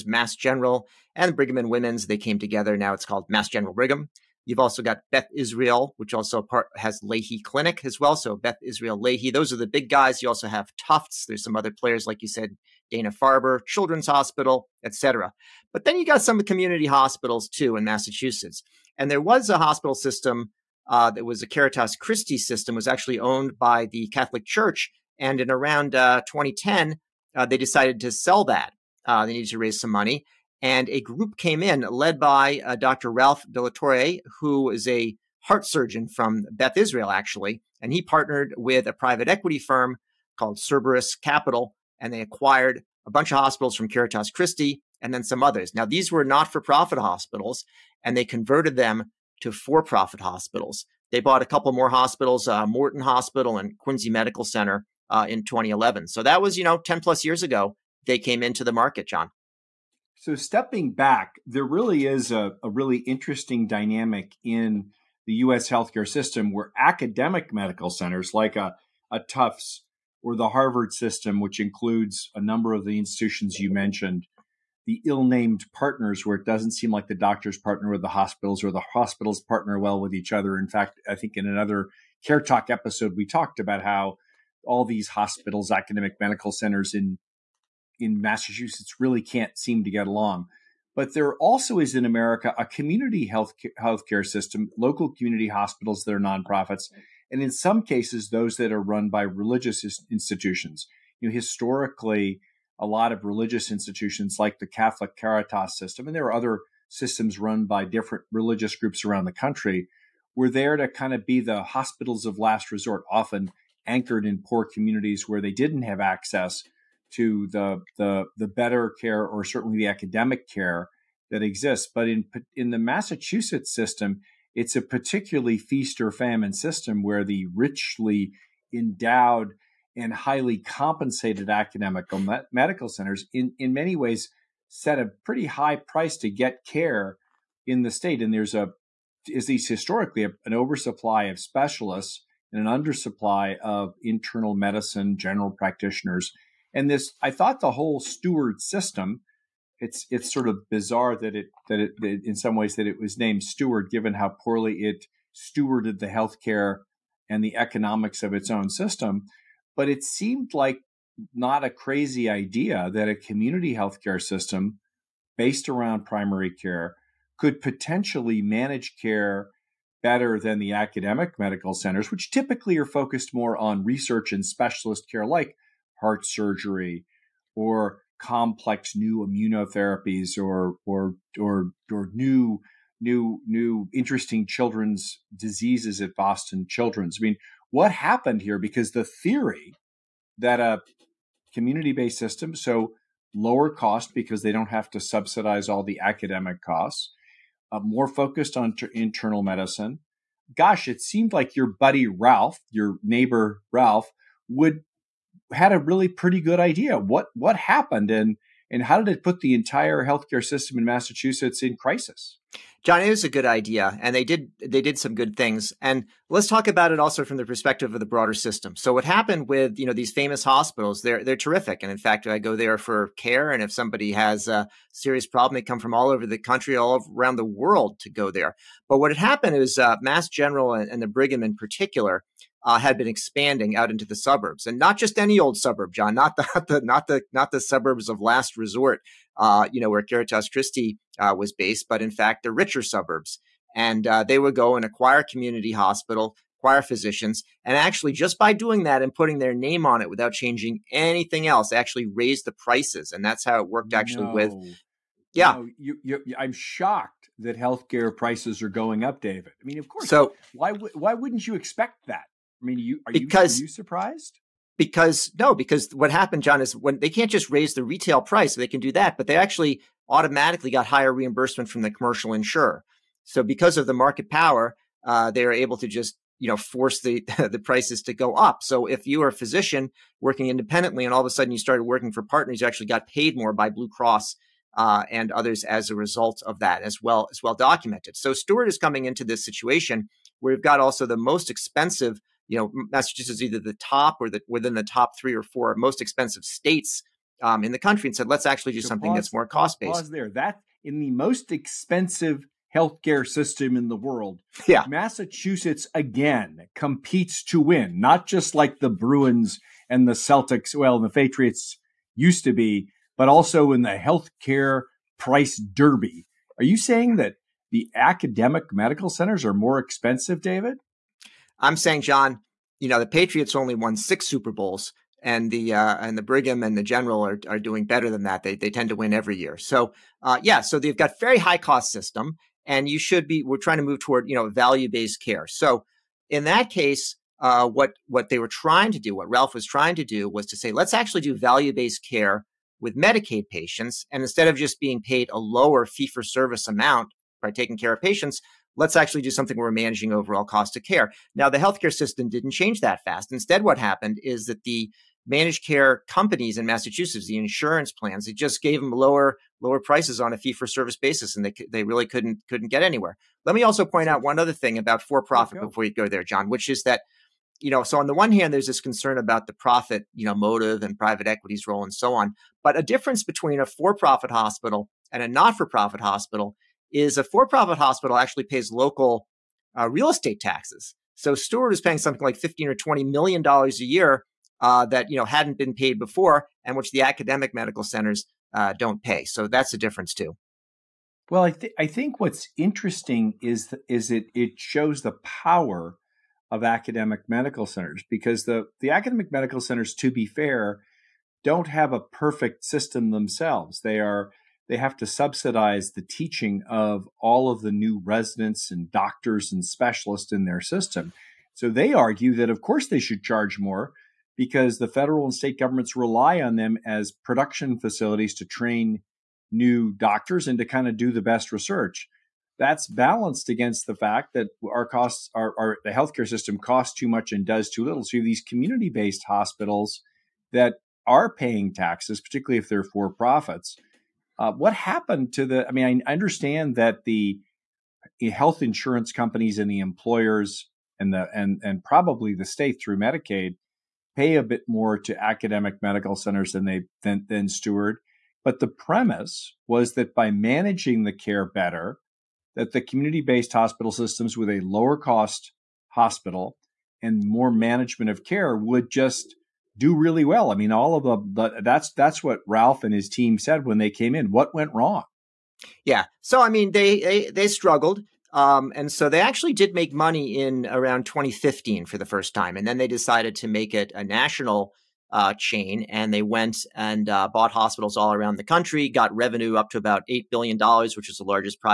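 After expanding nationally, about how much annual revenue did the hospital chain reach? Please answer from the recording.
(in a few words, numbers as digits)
$8 billion.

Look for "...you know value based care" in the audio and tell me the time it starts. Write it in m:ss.
5:34.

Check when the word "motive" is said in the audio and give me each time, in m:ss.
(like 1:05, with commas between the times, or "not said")
6:10.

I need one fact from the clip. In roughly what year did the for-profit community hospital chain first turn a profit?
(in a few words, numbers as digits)
2015.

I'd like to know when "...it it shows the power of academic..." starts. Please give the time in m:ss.
6:34.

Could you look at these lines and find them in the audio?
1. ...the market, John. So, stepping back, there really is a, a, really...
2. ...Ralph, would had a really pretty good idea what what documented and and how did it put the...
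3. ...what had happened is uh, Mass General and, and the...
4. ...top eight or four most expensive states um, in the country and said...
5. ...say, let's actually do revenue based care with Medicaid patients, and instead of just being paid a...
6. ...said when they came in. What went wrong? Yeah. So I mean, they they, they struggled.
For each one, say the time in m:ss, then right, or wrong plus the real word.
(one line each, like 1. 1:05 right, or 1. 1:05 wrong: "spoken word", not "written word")
1. 0:58 right
2. 3:23 wrong: "happened", not "documented"
3. 3:48 right
4. 4:54 wrong: "three", not "eight"
5. 5:40 wrong: "value", not "revenue"
6. 7:43 right.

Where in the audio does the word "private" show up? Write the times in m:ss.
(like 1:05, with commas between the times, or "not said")
0:38, 6:10.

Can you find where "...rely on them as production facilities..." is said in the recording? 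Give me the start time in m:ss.
6:55.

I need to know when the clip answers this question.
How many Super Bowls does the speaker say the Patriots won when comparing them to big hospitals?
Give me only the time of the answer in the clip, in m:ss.
5:23.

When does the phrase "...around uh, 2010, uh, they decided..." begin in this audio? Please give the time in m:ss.
0:25.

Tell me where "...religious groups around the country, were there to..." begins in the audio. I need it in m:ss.
1:48.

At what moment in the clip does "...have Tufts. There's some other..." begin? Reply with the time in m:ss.
0:10.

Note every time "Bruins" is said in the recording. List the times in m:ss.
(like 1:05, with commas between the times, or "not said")
5:08.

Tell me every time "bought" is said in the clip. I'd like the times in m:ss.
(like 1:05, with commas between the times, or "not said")
0:51, 7:57.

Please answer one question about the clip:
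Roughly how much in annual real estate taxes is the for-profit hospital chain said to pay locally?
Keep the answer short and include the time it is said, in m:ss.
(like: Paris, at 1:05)
$15 to 20 million, at 6:22.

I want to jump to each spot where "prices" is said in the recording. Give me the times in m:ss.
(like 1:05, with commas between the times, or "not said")
2:15, 4:12, 4:18, 4:28, 4:37, 5:15, 5:59.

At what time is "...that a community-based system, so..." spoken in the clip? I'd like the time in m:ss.
3:10.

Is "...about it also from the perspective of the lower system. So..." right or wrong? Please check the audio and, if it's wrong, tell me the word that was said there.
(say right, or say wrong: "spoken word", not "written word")
wrong: "broader", not "lower".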